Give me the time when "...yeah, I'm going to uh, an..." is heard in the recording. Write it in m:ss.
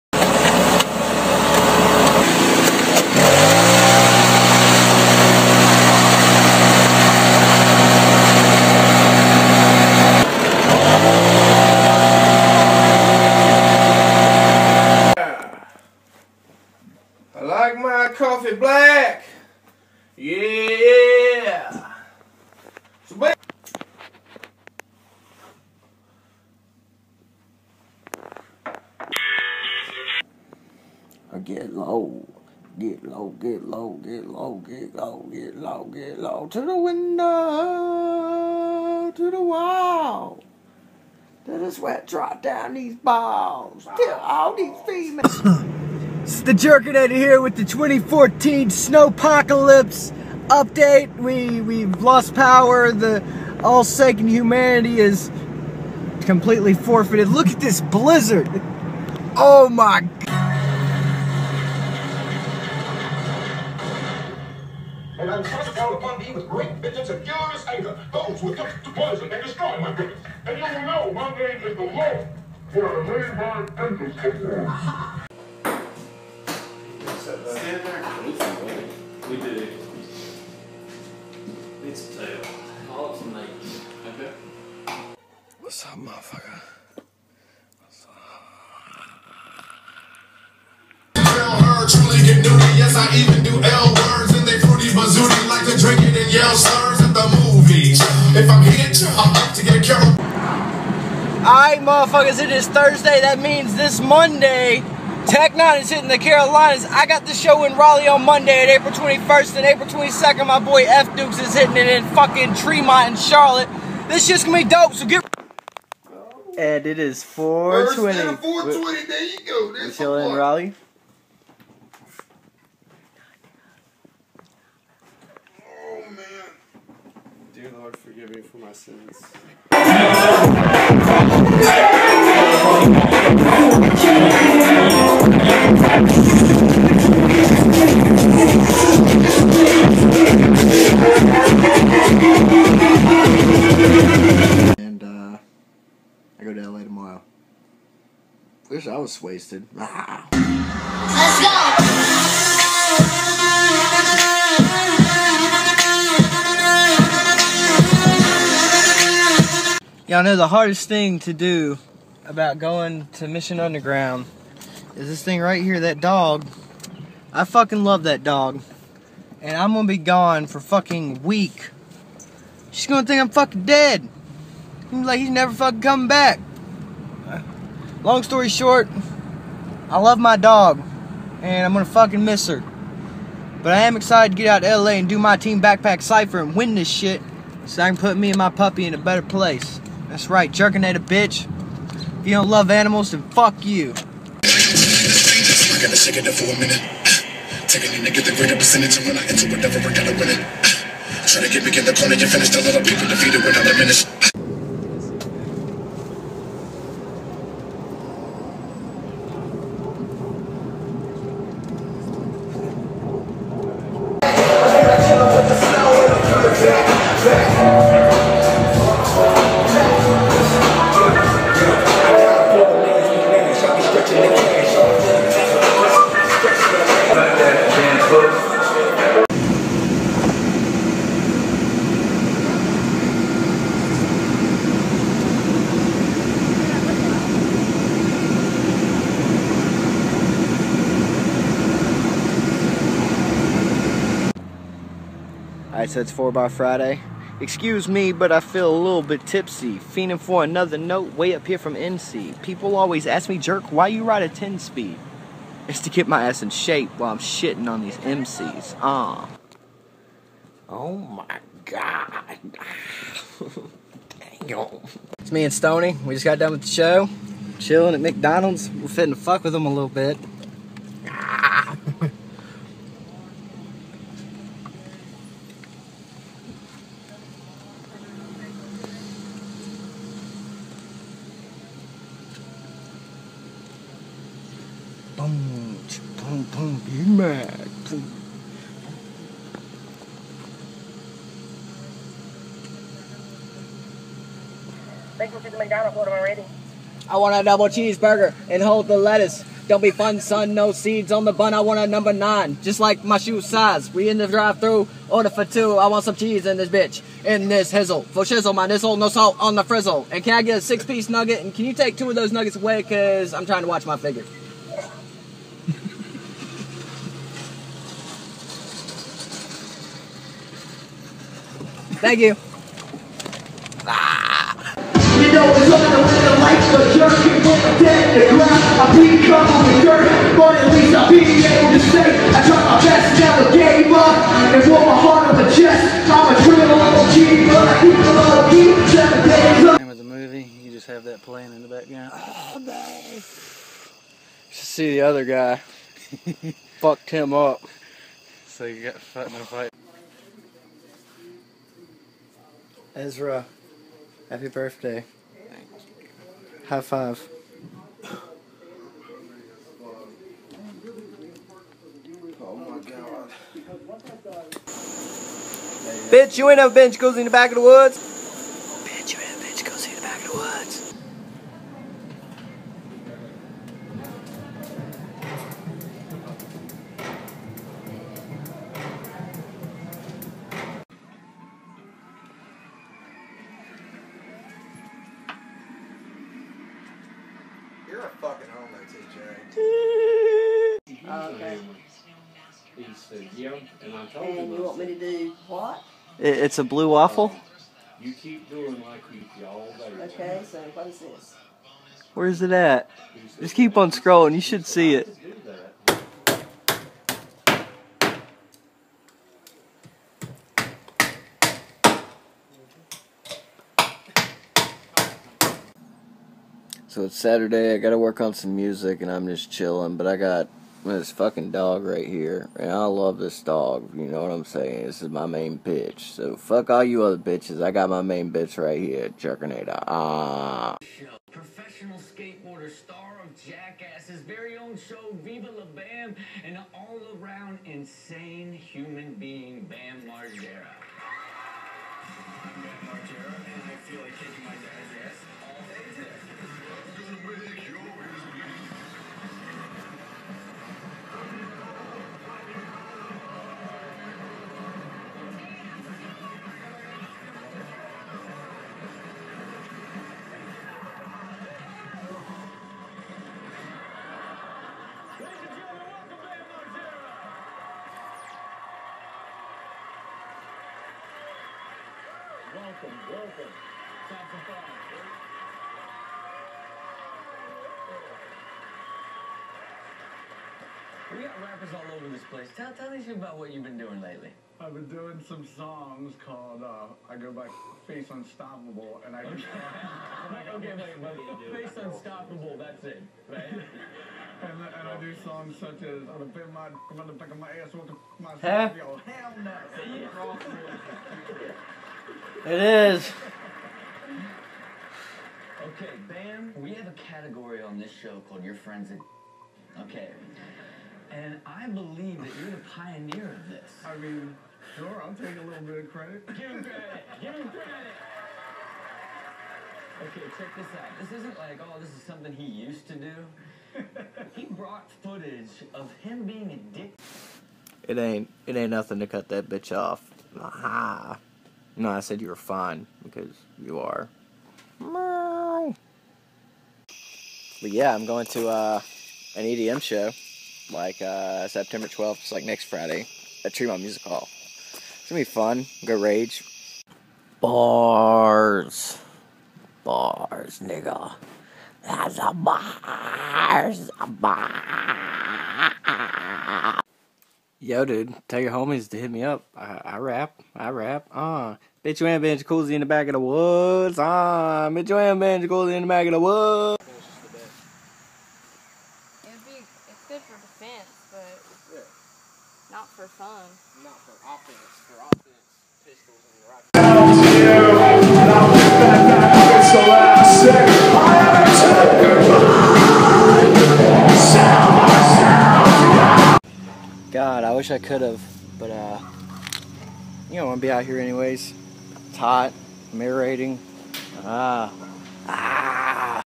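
8:57.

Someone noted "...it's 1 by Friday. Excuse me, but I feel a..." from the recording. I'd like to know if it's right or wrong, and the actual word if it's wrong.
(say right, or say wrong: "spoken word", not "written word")
wrong: "4", not "1".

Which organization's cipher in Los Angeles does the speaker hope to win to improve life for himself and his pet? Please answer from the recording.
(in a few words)
TeamBackPack.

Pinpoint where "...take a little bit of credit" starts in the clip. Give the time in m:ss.
8:35.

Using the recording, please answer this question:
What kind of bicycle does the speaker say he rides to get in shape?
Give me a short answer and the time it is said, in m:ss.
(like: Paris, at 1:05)
10 speed, at 4:14.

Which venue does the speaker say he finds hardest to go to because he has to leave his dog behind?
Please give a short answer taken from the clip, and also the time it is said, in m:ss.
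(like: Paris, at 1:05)
Mission Underground, at 2:43.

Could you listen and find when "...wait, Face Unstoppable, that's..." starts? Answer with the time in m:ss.
8:11.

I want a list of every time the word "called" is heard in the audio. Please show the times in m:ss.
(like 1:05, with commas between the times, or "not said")
8:06, 8:28.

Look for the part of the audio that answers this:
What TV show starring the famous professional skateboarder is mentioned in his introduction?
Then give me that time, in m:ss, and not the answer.
7:15.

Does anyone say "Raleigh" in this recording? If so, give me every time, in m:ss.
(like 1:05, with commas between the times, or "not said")
1:47, 2:00.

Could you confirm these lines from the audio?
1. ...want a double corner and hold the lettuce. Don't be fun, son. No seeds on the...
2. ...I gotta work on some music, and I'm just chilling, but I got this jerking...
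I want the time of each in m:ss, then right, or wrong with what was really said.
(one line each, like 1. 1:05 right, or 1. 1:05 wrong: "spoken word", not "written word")
1. 4:57 wrong: "cheeseburger", not "corner"
2. 6:57 wrong: "fucking", not "jerking".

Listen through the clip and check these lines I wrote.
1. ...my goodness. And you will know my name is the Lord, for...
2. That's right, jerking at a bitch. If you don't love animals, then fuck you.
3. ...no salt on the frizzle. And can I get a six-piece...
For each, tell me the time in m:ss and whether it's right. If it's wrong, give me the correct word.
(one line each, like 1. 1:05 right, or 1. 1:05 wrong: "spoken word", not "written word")
1. 1:09 right
2. 3:10 right
3. 5:08 right.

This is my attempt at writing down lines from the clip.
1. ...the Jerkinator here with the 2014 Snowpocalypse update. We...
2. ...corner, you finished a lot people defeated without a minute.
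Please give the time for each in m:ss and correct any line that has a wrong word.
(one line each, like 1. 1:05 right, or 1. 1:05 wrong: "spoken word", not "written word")
1. 0:46 right
2. 3:21 right.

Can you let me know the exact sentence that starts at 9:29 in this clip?
It'd be, it's good for defense, but yeah.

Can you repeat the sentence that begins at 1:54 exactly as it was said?
This shit's gonna be dope, so get.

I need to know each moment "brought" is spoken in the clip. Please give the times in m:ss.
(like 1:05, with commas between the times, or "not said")
8:44.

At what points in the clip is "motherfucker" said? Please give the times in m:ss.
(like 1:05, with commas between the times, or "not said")
1:25, 1:41.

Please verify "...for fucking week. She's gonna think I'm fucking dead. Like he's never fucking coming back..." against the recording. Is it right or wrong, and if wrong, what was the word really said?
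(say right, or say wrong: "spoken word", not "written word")
right.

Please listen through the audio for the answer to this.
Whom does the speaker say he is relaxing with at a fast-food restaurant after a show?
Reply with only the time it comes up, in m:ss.
4:25.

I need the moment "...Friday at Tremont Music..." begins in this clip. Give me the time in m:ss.
9:02.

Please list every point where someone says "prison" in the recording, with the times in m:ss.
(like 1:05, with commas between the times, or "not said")
not said.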